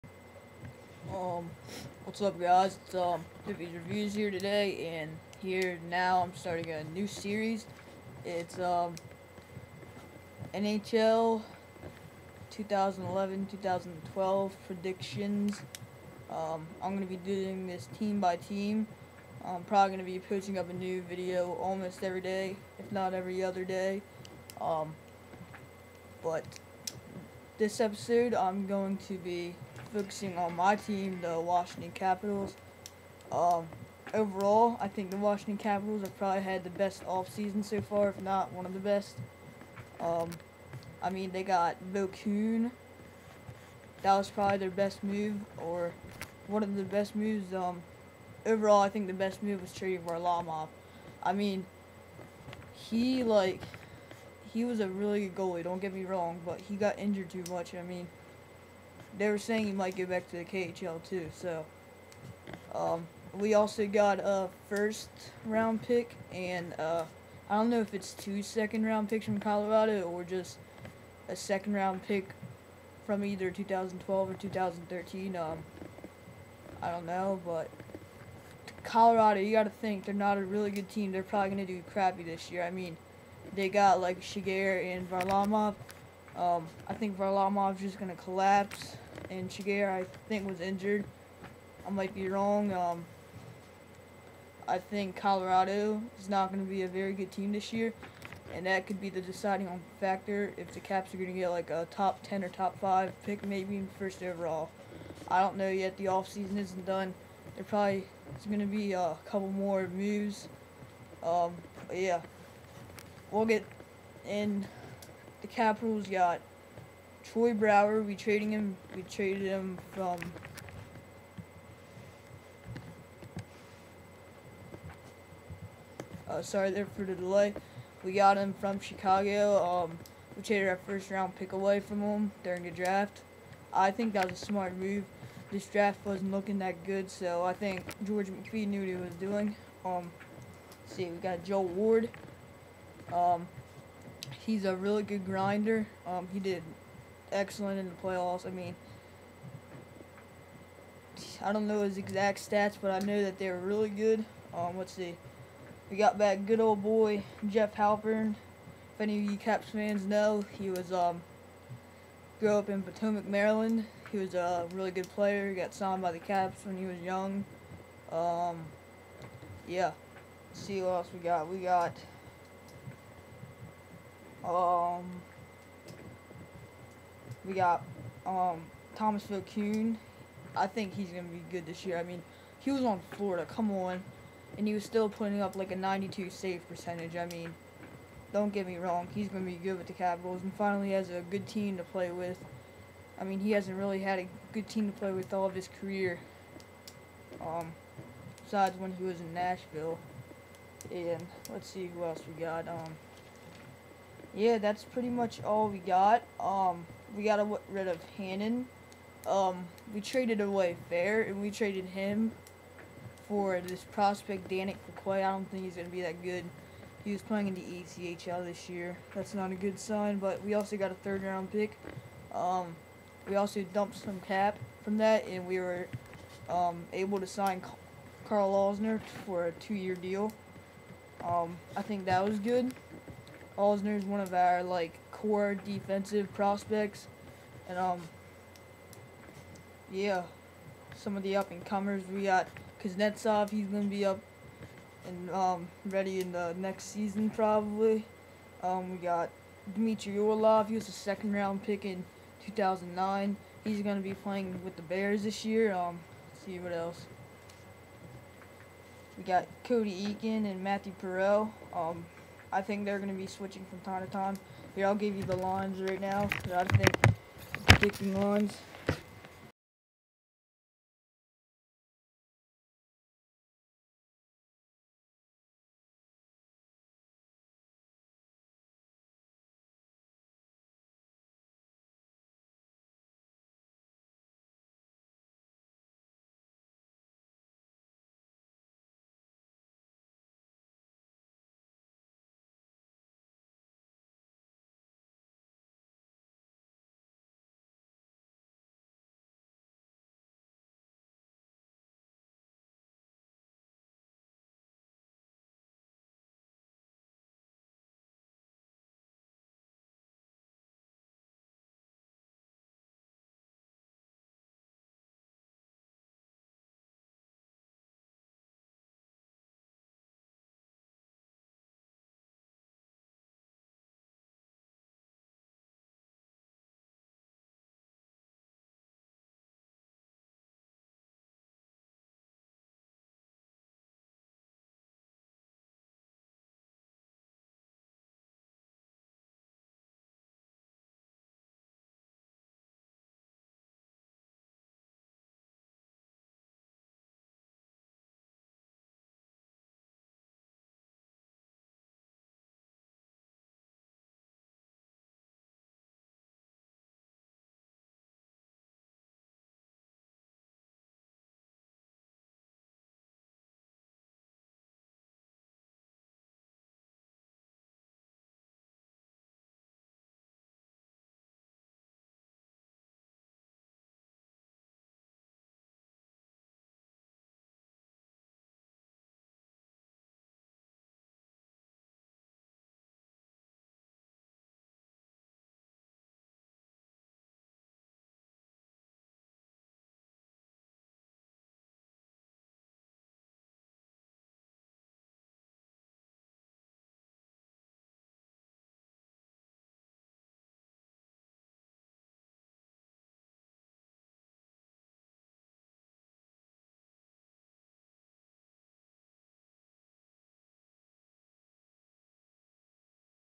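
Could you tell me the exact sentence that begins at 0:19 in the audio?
I'm probably going to be posting up a new video almost every day, if not every other day.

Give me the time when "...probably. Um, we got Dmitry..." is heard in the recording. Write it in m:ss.
4:07.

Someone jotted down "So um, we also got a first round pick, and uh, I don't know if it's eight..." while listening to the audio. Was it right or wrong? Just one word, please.
wrong.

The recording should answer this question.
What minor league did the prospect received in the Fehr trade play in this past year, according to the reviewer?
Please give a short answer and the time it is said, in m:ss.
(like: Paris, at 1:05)
ECHL, at 3:37.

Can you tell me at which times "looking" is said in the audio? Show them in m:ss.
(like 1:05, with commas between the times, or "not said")
2:16.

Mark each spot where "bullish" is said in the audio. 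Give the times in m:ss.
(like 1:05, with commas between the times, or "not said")
not said.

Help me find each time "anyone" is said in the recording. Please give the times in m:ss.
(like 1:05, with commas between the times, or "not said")
not said.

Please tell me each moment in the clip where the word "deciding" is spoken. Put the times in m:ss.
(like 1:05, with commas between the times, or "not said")
1:39.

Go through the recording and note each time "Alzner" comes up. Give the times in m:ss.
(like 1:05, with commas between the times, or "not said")
3:48, 3:53.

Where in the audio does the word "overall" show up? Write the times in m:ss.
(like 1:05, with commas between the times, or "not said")
0:34, 0:48, 1:44.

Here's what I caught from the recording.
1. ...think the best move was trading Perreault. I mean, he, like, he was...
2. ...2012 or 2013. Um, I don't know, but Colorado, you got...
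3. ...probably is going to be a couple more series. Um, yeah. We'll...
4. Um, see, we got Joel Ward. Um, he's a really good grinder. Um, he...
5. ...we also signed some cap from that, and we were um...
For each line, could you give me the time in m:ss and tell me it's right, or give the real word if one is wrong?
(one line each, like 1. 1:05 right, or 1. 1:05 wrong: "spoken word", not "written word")
1. 0:48 wrong: "Varlamov", not "Perreault"
2. 1:13 right
3. 1:47 wrong: "moves", not "series"
4. 2:19 right
5. 3:43 wrong: "dumped", not "signed".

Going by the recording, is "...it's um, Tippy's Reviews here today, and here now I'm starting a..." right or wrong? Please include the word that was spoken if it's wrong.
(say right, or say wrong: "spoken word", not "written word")
right.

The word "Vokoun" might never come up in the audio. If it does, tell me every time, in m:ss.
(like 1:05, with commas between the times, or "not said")
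2:59.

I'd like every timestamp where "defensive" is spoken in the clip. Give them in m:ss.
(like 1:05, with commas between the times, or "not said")
3:55.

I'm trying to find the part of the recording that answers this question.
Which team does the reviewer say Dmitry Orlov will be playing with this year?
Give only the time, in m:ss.
4:14.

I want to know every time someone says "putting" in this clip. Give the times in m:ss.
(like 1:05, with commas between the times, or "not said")
3:05.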